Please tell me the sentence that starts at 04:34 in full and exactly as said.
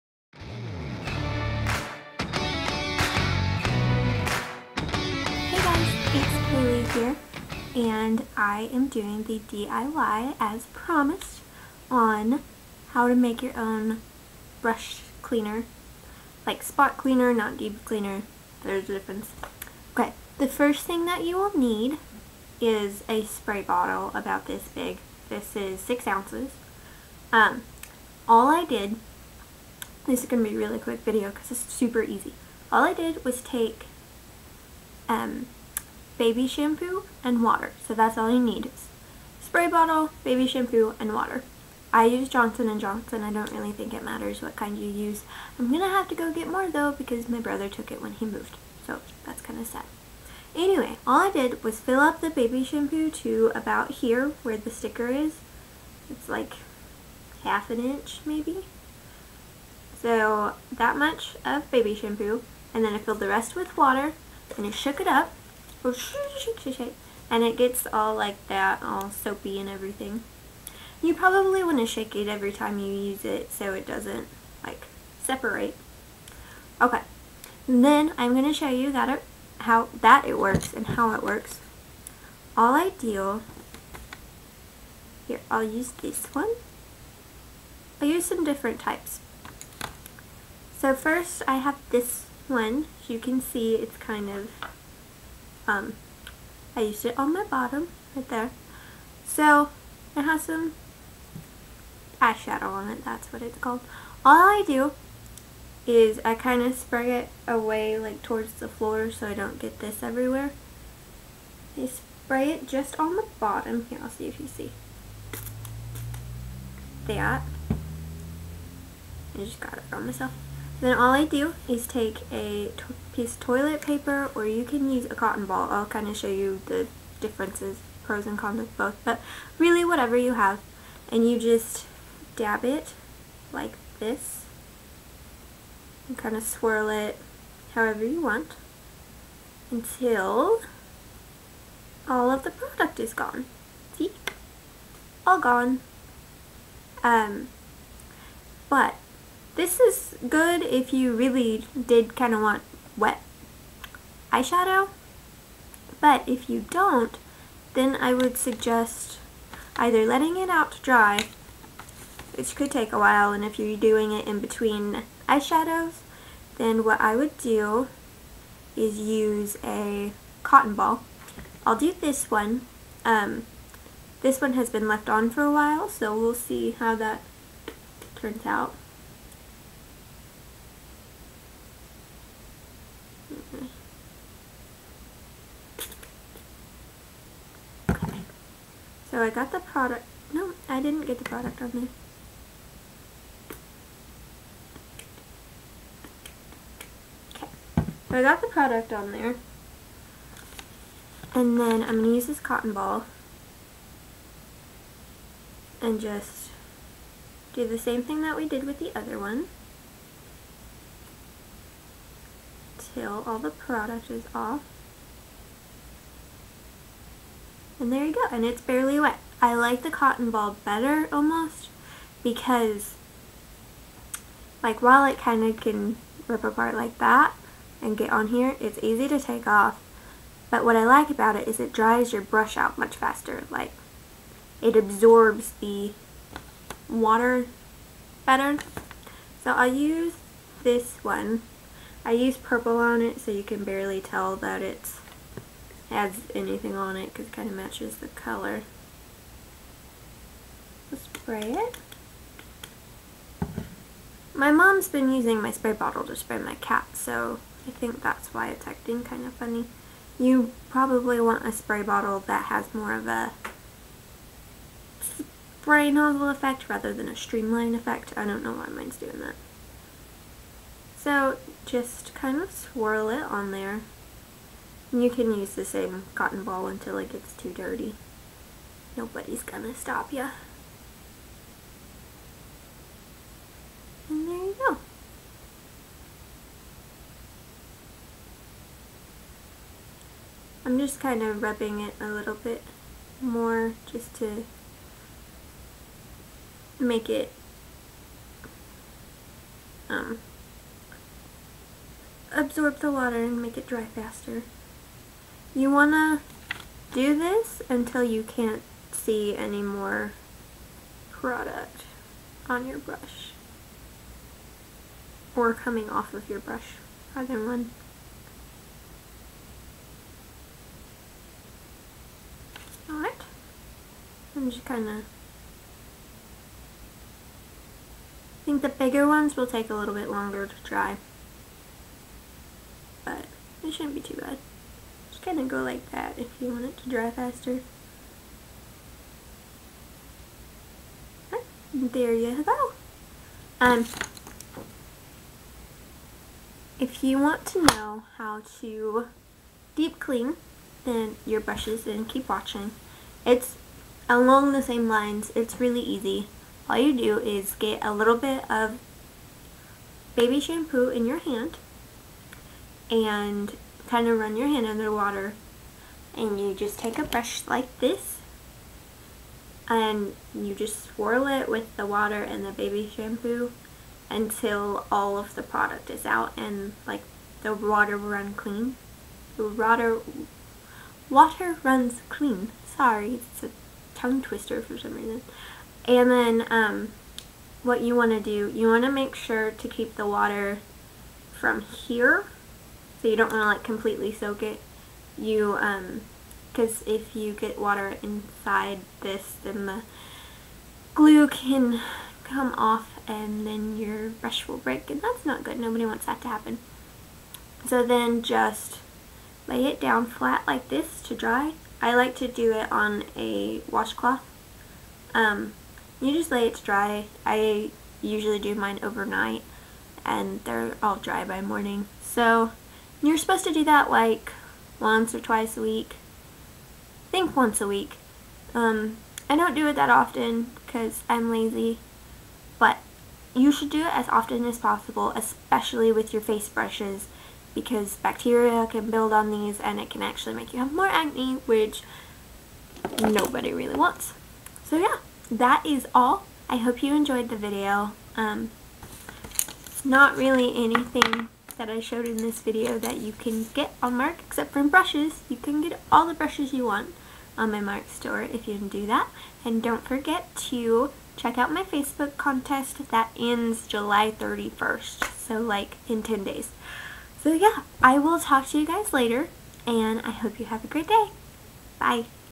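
And you can use the same cotton ball until it gets too dirty.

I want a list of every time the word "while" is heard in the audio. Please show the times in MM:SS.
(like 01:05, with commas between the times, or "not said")
02:42, 02:55, 03:44.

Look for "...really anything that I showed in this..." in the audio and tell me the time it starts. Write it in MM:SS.
07:30.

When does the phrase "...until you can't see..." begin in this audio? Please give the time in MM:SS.
05:07.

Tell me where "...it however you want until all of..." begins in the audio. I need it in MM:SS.
02:16.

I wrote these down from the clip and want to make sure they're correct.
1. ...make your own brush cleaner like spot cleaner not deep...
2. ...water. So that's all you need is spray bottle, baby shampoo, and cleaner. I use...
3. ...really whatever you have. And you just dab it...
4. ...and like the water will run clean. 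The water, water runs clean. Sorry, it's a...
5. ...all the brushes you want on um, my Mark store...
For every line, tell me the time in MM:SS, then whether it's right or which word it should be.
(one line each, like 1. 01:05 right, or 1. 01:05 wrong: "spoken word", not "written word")
1. 00:13 right
2. 00:37 wrong: "water", not "cleaner"
3. 02:09 right
4. 06:16 right
5. 07:35 right.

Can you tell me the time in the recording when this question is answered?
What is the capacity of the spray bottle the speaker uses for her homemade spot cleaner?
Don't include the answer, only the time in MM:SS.
00:25.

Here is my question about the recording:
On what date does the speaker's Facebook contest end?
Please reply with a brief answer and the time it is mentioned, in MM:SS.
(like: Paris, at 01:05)
July 31st, at 07:43.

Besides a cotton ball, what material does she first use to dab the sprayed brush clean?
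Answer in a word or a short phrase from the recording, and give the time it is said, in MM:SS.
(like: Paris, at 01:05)
toilet paper, at 02:03.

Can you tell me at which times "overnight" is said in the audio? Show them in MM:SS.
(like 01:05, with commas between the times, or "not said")
06:58.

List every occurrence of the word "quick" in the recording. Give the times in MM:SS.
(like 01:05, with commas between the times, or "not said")
00:30.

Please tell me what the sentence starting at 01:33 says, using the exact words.
you can see, it's kind of um, I used it on my bottom right there.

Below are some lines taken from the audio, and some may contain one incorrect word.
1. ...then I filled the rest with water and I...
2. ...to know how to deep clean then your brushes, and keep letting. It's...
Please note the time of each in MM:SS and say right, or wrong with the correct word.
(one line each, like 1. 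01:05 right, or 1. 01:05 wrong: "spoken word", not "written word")
1. 01:02 right
2. 05:47 wrong: "watching", not "letting".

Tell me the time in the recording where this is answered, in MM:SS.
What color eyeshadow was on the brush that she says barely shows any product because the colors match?
04:02.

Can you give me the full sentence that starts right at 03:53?
Like it absorbs the water better.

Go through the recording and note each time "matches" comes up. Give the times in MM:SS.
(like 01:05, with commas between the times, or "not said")
04:07.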